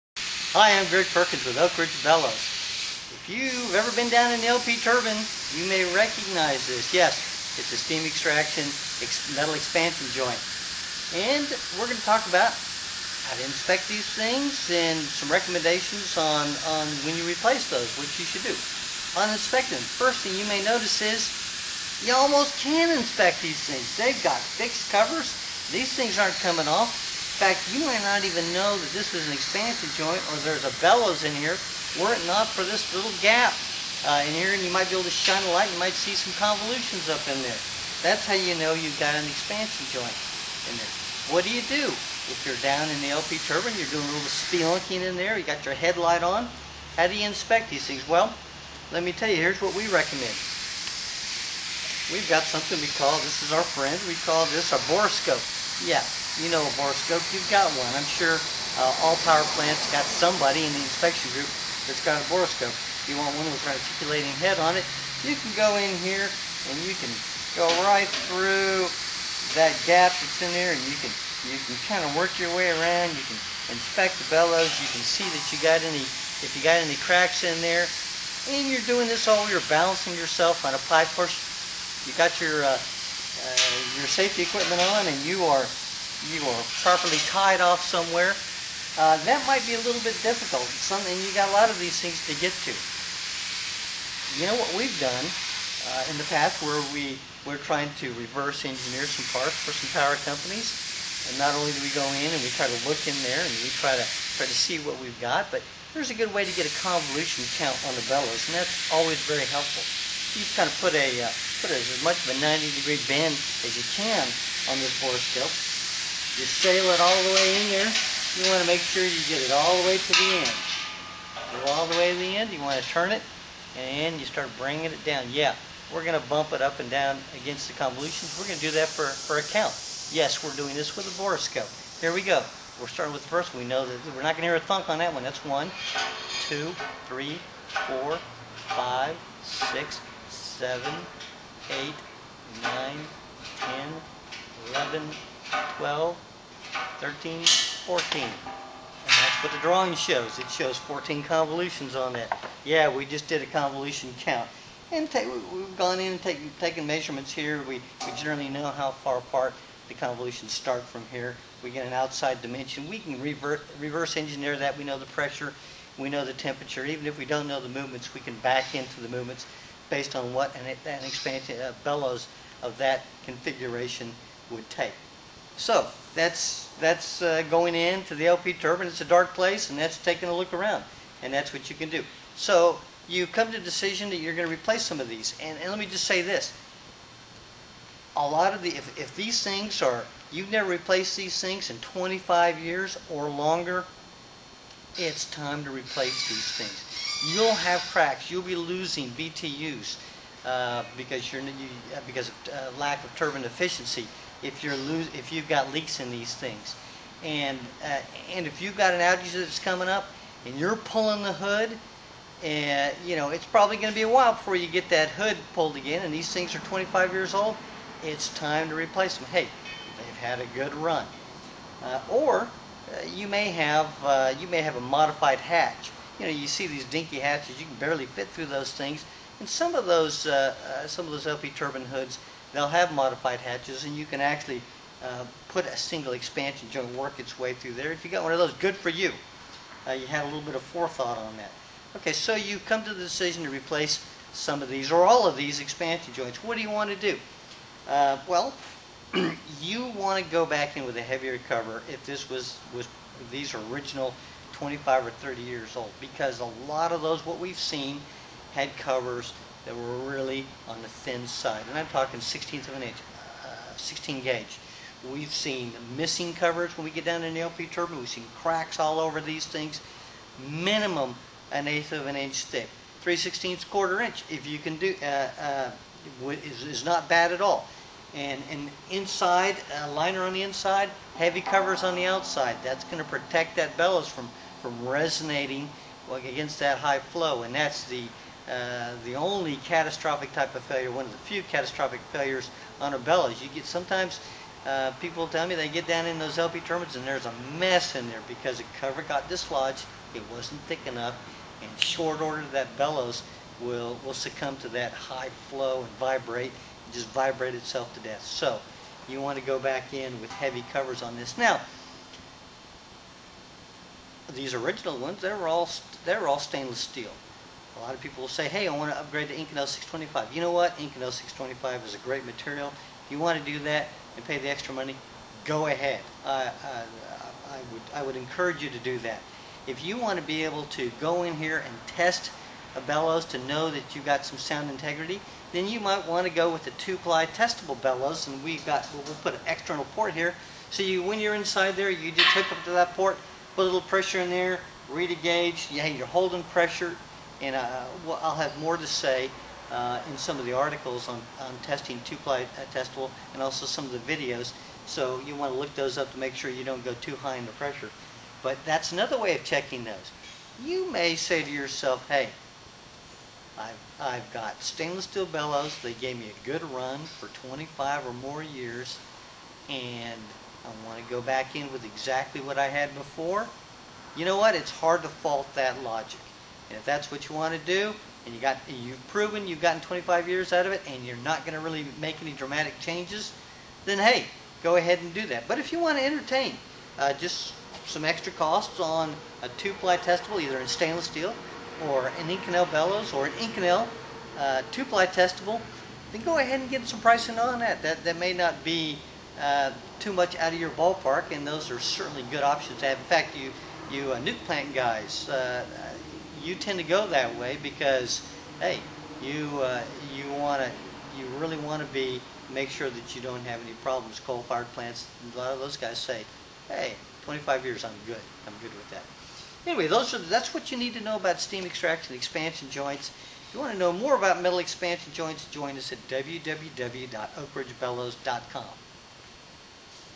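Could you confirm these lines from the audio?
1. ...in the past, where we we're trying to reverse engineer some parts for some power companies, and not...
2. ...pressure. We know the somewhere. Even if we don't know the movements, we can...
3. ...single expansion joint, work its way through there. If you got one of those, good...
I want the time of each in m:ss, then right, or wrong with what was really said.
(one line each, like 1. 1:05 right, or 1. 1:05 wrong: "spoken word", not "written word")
1. 1:36 right
2. 2:45 wrong: "temperature", not "somewhere"
3. 3:55 right.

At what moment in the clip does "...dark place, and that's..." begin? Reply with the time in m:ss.
2:59.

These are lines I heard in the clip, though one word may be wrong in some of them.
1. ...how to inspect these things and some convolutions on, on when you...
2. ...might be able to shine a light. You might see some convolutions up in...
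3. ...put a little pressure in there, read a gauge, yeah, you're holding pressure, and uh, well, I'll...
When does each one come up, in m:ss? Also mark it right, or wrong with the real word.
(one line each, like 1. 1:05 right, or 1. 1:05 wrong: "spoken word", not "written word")
1. 0:12 wrong: "recommendations", not "convolutions"
2. 0:34 right
3. 5:43 right.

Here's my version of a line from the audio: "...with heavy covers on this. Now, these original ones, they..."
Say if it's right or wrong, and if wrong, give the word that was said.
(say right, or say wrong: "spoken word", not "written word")
right.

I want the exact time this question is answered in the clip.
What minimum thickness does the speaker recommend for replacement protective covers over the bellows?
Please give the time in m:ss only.
4:31.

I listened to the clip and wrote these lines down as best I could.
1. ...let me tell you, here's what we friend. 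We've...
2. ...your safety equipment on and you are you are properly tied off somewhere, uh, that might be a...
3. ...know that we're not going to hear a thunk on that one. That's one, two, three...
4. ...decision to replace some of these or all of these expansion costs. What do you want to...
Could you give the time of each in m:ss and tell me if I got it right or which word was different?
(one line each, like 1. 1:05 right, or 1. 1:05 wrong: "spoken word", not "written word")
1. 0:48 wrong: "recommend", not "friend"
2. 1:23 right
3. 2:13 right
4. 4:03 wrong: "joints", not "costs".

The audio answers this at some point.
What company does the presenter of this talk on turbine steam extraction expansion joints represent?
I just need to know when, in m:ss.
0:01.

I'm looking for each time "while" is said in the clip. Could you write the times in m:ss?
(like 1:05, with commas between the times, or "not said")
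3:34.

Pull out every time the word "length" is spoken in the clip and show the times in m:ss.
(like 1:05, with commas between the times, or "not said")
not said.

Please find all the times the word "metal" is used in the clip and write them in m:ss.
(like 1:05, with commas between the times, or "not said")
0:09, 7:04.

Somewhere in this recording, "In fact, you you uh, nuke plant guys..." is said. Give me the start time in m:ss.
6:42.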